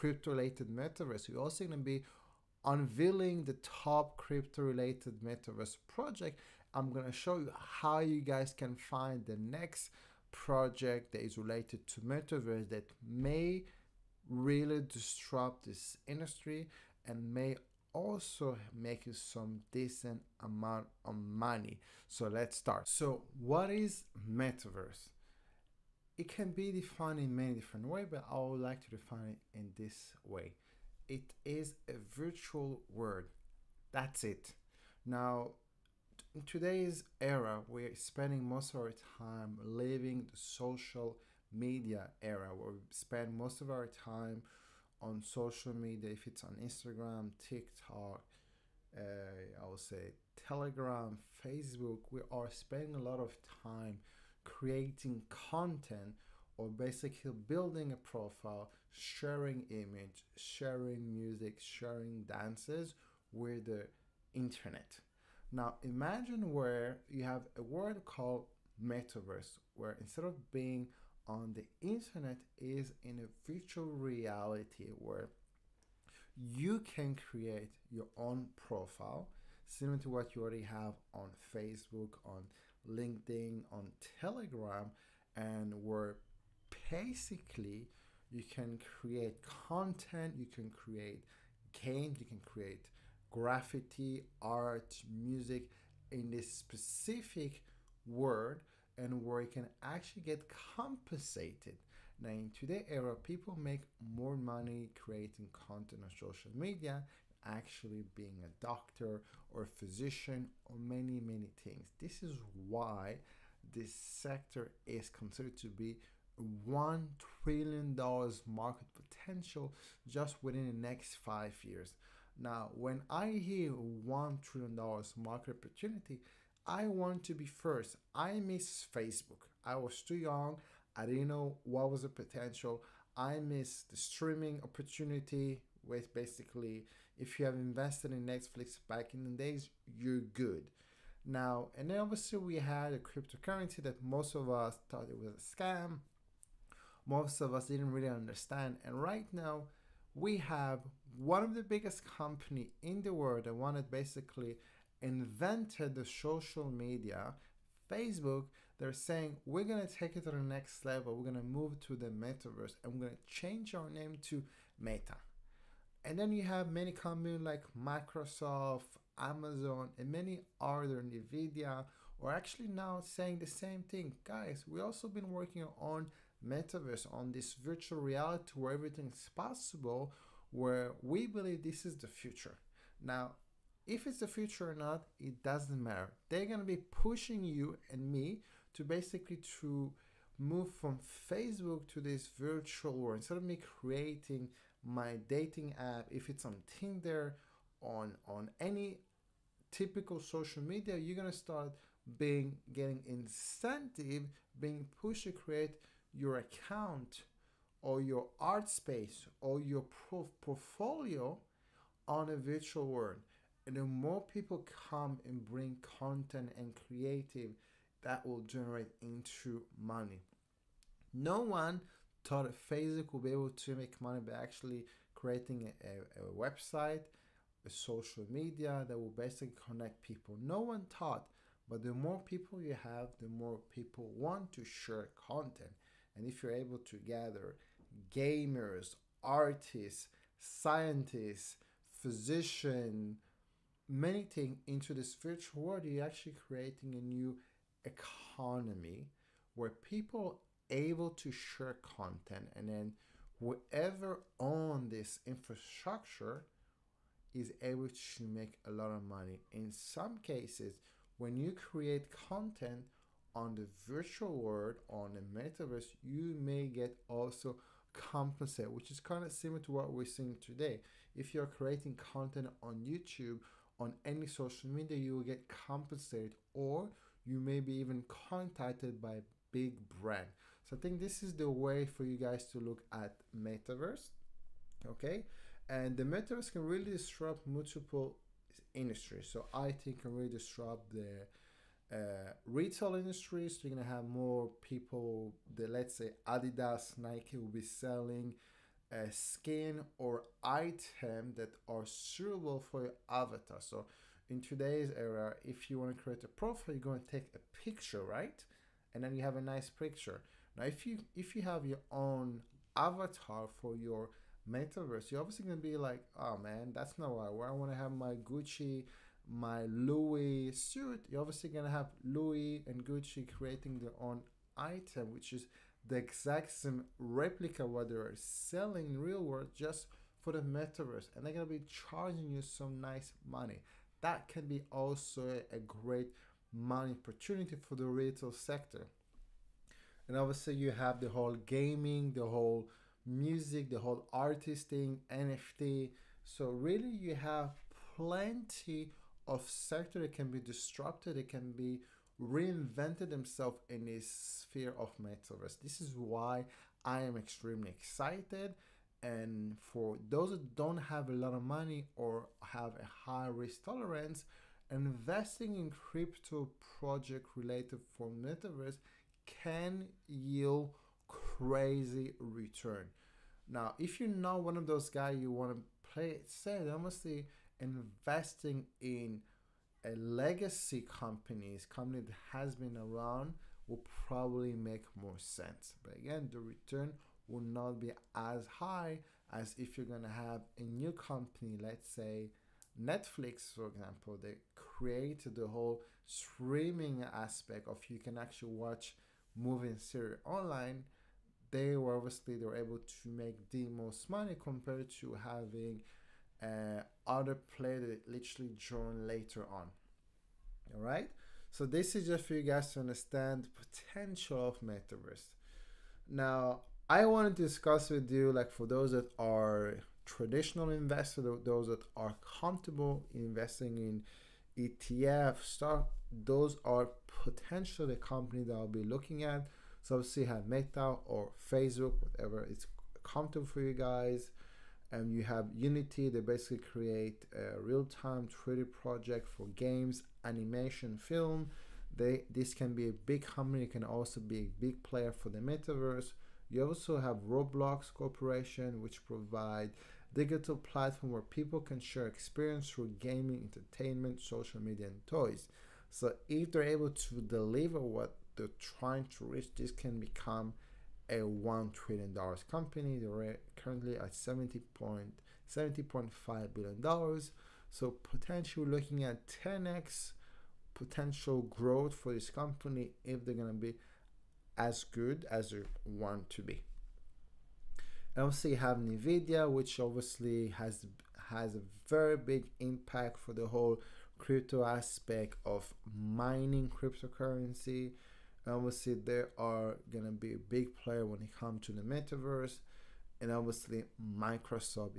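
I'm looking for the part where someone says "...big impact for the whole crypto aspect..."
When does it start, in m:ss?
8:02.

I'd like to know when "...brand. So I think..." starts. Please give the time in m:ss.
4:39.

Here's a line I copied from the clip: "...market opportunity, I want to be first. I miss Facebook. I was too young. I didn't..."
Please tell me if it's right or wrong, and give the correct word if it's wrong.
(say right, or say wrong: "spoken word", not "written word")
right.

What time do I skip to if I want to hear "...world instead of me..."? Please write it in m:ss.
3:12.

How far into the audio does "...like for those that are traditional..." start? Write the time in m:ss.
6:58.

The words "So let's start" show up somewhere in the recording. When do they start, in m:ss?
0:22.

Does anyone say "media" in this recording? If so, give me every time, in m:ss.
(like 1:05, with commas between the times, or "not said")
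0:41, 0:45, 1:46, 2:36, 3:20, 3:48, 4:34, 7:34.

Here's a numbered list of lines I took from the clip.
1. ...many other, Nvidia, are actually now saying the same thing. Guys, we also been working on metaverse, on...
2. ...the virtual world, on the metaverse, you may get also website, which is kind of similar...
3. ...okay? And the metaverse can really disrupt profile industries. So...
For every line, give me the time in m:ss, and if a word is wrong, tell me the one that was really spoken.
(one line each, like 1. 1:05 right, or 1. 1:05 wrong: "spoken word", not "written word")
1. 2:50 right
2. 4:23 wrong: "compensate", not "website"
3. 4:44 wrong: "multiple", not "profile".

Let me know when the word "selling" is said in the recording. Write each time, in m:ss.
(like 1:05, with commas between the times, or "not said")
4:57, 5:28.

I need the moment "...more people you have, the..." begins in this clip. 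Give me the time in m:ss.
3:51.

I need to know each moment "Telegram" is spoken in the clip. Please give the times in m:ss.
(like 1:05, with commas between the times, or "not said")
0:50, 1:24.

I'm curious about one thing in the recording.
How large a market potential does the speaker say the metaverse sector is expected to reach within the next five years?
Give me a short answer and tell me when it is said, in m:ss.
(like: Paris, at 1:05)
$1 trillion, at 1:56.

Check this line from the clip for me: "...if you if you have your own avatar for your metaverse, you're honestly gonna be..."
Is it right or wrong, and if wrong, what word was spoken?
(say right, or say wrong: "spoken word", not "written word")
wrong: "obviously", not "honestly".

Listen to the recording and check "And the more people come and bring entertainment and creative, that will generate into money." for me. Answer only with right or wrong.
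wrong.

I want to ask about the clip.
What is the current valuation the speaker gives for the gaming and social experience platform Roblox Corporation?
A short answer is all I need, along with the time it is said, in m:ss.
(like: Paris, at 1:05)
$70.5 billion, at 7:45.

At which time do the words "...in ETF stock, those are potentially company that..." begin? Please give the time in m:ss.
7:03.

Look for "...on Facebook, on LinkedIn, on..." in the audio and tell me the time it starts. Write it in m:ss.
1:21.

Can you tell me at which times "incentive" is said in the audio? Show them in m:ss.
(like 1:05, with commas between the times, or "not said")
3:23.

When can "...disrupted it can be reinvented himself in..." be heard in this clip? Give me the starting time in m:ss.
5:50.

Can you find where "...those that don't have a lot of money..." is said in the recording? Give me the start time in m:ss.
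6:00.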